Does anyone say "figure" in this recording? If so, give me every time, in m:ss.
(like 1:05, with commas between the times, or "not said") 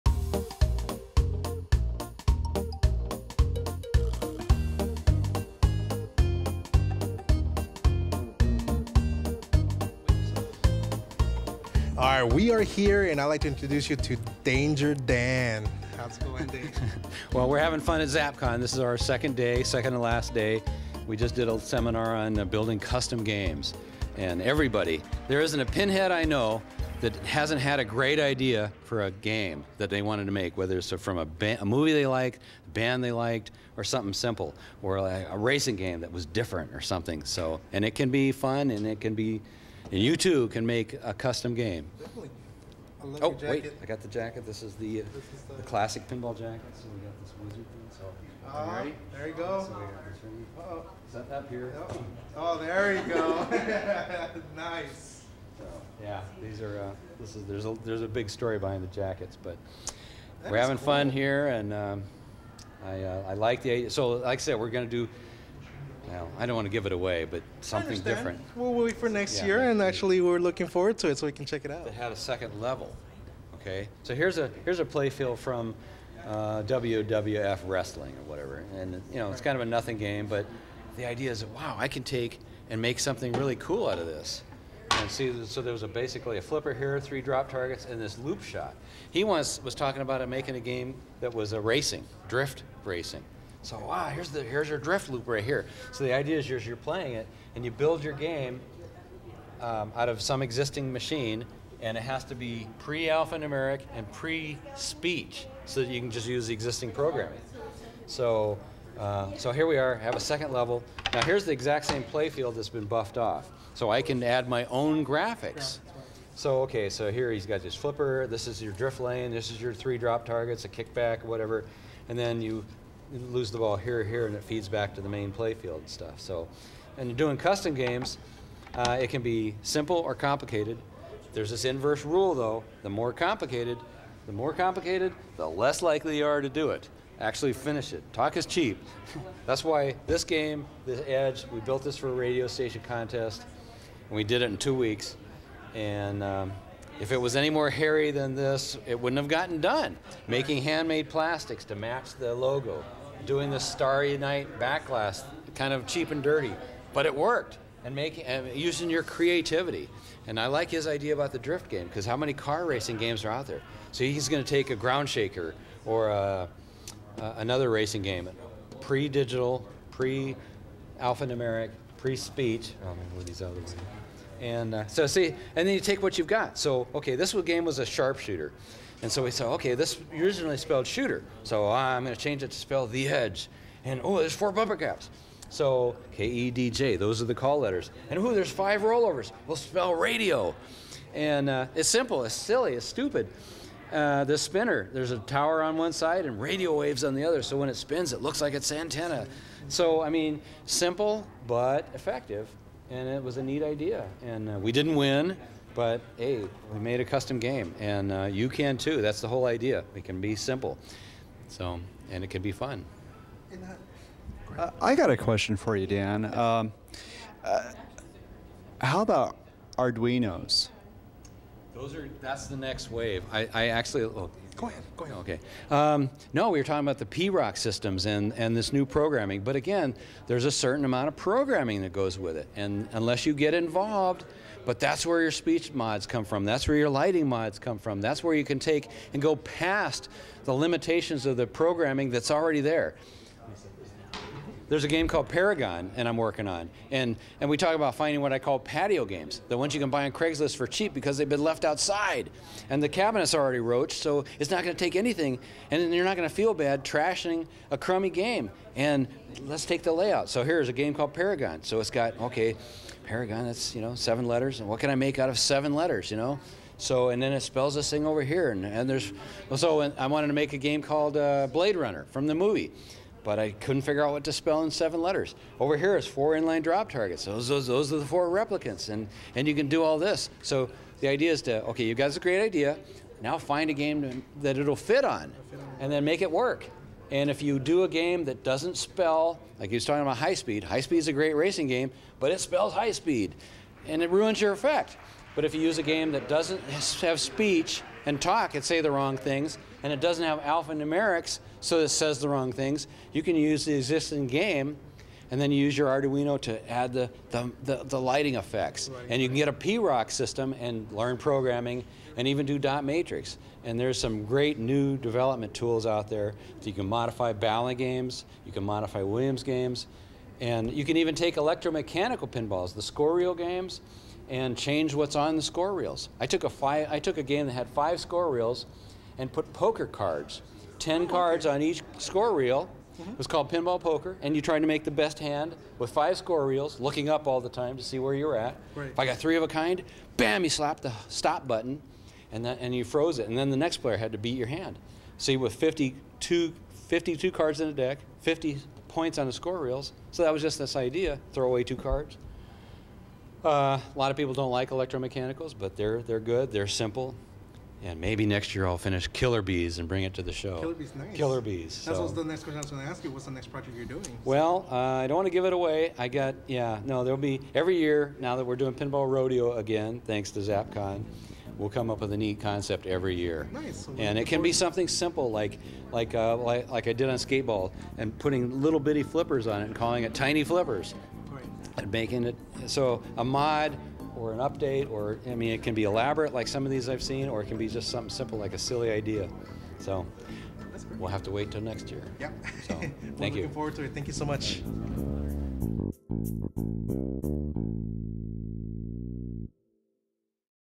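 4:33.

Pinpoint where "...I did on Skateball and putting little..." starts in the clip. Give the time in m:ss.
6:16.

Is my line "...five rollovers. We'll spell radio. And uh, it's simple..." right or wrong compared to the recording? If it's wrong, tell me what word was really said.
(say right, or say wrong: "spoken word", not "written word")
right.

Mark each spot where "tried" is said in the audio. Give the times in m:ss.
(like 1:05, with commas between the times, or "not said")
5:34.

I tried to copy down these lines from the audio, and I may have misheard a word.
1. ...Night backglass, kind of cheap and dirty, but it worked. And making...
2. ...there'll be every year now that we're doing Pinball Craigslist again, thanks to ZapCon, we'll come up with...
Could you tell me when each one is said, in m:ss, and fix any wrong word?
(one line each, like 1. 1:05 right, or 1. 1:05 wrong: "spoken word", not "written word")
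1. 2:34 right
2. 6:07 wrong: "Rodeo", not "Craigslist".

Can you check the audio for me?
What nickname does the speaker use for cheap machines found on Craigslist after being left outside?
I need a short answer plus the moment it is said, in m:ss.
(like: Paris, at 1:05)
patio games, at 4:08.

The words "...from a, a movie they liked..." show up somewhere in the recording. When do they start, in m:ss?
0:30.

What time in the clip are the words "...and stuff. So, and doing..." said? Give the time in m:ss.
2:05.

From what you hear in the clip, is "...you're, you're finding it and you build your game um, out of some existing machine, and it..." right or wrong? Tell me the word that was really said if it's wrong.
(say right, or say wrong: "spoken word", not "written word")
wrong: "playing", not "finding".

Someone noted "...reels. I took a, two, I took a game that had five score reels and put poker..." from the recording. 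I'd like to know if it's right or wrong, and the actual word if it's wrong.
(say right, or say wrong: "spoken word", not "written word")
wrong: "five", not "two".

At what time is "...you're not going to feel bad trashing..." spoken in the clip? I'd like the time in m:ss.
4:15.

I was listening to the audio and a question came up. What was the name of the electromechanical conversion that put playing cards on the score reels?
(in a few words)
Pinball Poker.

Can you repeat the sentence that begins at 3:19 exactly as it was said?
So I mean, simple but effective.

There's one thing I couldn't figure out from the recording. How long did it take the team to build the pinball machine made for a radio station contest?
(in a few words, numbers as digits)
2 weeks.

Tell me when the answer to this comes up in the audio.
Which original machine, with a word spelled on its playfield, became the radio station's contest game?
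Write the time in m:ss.
2:57.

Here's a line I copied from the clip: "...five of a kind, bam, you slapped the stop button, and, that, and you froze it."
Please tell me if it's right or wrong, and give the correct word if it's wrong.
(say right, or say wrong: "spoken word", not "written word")
wrong: "three", not "five".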